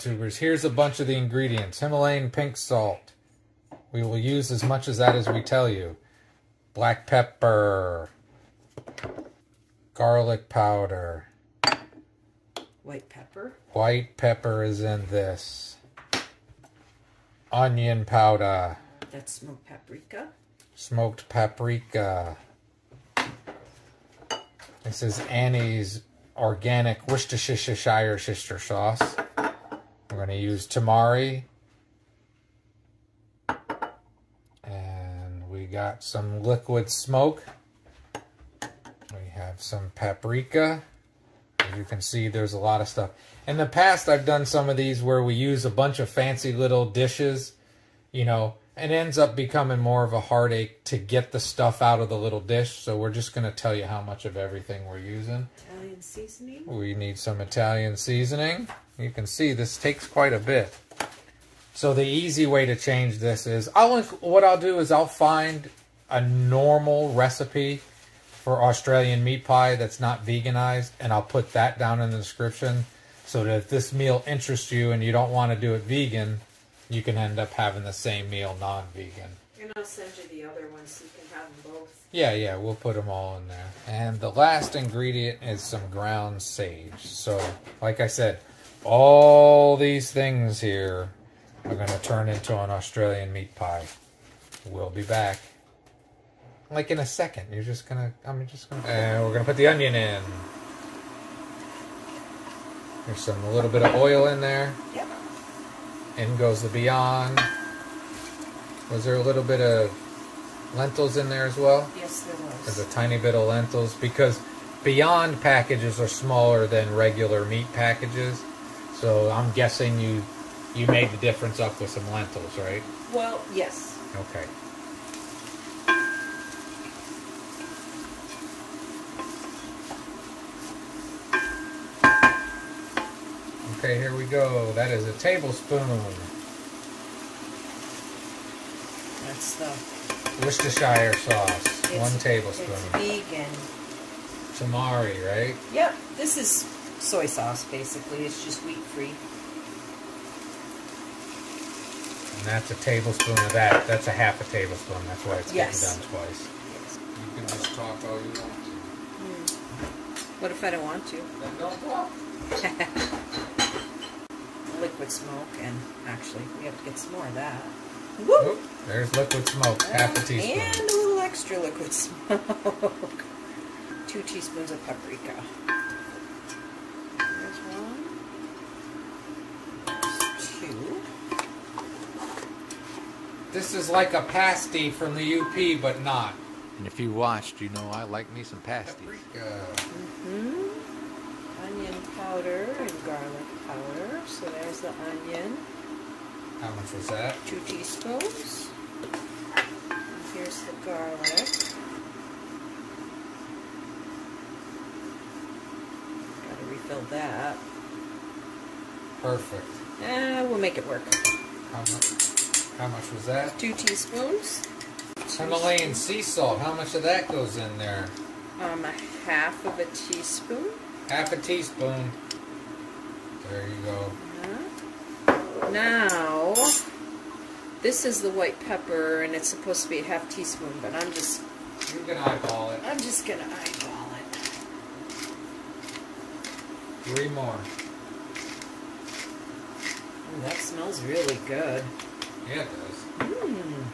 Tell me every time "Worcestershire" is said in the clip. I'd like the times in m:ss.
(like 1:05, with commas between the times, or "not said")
0:27, 2:20.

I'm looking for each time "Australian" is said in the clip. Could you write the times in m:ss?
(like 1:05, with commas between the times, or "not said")
1:08, 1:32.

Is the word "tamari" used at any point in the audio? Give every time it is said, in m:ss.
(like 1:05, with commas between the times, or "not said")
0:30, 2:24.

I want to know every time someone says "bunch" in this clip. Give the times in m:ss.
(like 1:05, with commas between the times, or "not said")
0:00, 0:45.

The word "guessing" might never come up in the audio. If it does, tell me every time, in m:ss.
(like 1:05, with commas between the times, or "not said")
1:59.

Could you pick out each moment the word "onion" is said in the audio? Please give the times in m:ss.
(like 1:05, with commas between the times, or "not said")
0:17, 1:39, 3:15.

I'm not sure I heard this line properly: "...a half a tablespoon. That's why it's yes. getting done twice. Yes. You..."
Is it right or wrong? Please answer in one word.
right.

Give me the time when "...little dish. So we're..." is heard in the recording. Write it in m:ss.
0:52.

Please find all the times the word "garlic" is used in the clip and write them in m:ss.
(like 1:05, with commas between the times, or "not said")
0:09, 3:20.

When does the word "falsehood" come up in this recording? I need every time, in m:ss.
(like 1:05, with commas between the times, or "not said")
not said.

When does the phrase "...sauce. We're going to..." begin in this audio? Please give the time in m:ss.
0:28.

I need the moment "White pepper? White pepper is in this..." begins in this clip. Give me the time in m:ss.
0:12.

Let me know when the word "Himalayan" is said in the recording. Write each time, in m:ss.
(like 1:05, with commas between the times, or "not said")
0:01, 3:35.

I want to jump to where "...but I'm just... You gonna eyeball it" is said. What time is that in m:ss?
3:50.